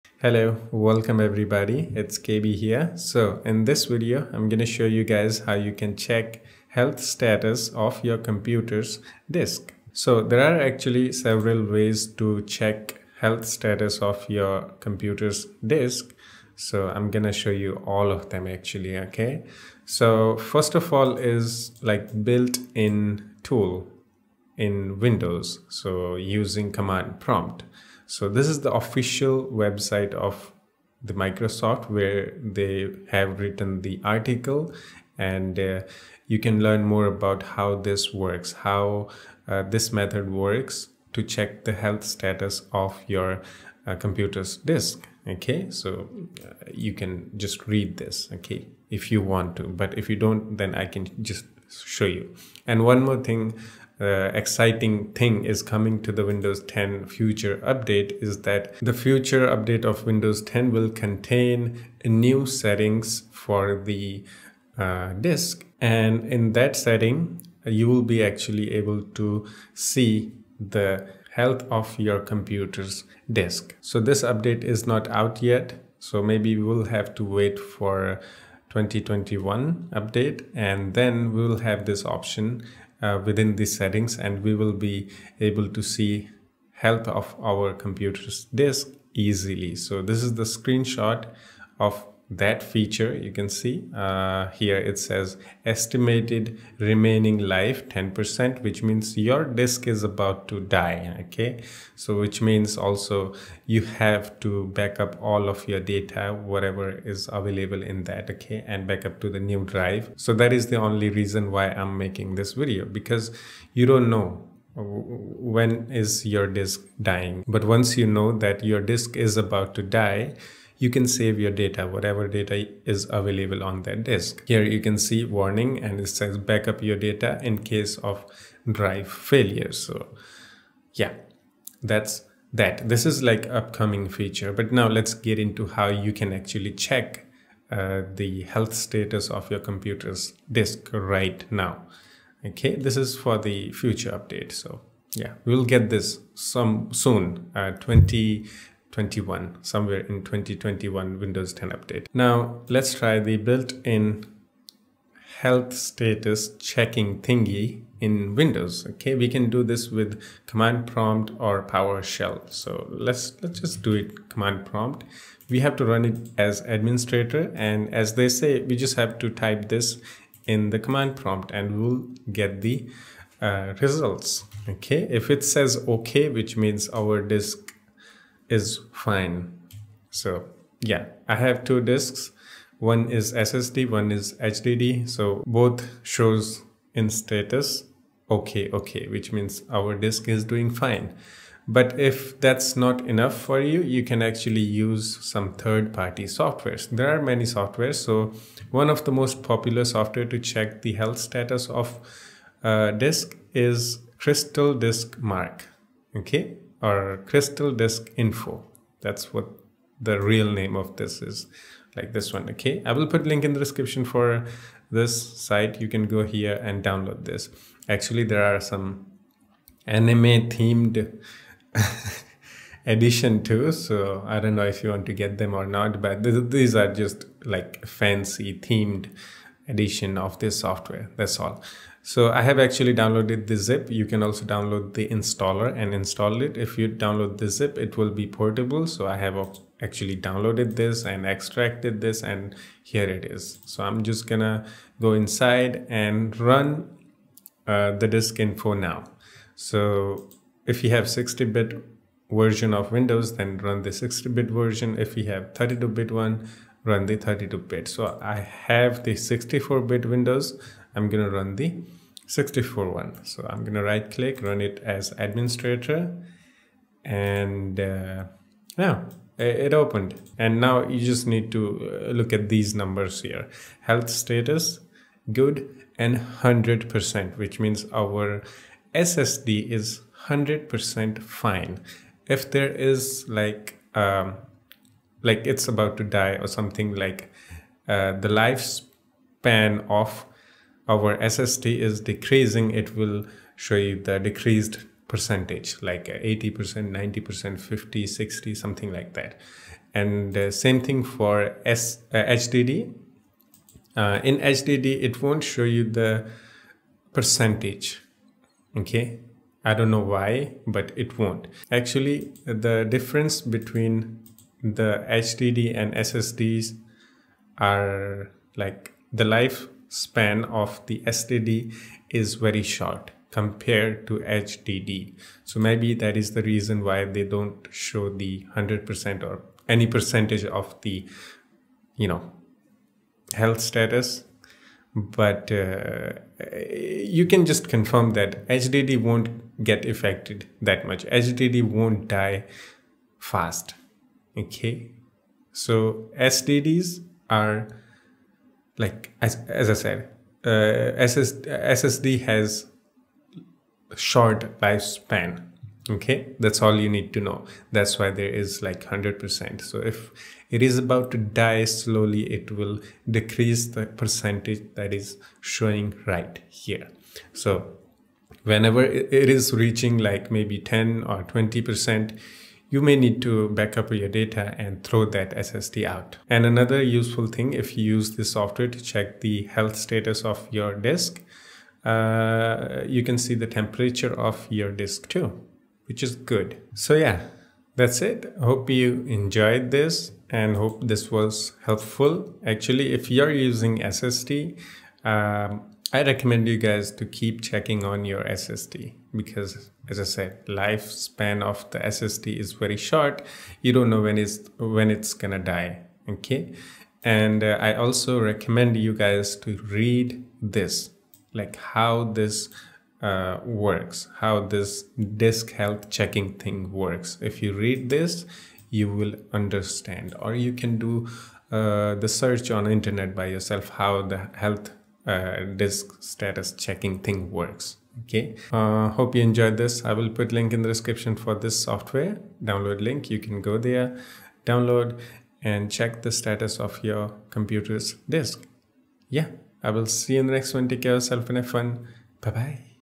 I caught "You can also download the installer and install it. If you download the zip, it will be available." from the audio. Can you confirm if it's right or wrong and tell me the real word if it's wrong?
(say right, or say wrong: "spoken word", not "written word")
wrong: "portable", not "available".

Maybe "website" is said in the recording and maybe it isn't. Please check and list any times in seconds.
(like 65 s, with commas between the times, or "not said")
29 s.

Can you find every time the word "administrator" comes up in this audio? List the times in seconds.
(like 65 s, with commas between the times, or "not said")
166 s, 265 s.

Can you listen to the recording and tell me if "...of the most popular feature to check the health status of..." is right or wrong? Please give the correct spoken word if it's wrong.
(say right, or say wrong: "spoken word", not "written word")
wrong: "software", not "feature".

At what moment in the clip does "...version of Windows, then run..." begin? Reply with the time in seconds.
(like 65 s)
252 s.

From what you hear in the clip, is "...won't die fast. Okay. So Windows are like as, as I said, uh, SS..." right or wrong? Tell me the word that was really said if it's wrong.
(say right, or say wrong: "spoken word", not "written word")
wrong: "SSDs", not "Windows".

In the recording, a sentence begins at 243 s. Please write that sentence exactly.
So I'm just gonna go inside and run uh, the disk info now.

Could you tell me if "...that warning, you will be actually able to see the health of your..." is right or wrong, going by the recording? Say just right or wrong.
wrong.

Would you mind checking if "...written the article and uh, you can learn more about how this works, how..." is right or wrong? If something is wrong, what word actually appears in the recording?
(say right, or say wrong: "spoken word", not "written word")
right.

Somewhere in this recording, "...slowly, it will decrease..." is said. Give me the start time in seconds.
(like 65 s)
361 s.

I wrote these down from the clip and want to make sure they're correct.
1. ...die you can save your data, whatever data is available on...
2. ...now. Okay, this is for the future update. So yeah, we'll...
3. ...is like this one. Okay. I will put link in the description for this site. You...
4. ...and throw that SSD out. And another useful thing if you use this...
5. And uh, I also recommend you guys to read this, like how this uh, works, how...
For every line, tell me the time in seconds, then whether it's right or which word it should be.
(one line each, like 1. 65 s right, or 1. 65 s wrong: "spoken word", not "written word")
1. 119 s right
2. 141 s right
3. 211 s right
4. 374 s right
5. 407 s right.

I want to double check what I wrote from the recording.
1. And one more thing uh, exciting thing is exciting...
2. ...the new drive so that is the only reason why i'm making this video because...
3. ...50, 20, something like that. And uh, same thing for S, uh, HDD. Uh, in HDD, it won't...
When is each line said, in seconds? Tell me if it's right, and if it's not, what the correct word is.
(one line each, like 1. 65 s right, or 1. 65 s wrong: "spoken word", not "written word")
1. 52 s wrong: "coming", not "exciting"
2. 109 s right
3. 297 s wrong: "60", not "20".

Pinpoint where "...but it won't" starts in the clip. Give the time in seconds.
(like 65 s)
310 s.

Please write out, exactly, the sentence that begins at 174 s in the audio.
Okay, if it says okay, which means our disk is fine.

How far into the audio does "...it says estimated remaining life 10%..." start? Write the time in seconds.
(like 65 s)
94 s.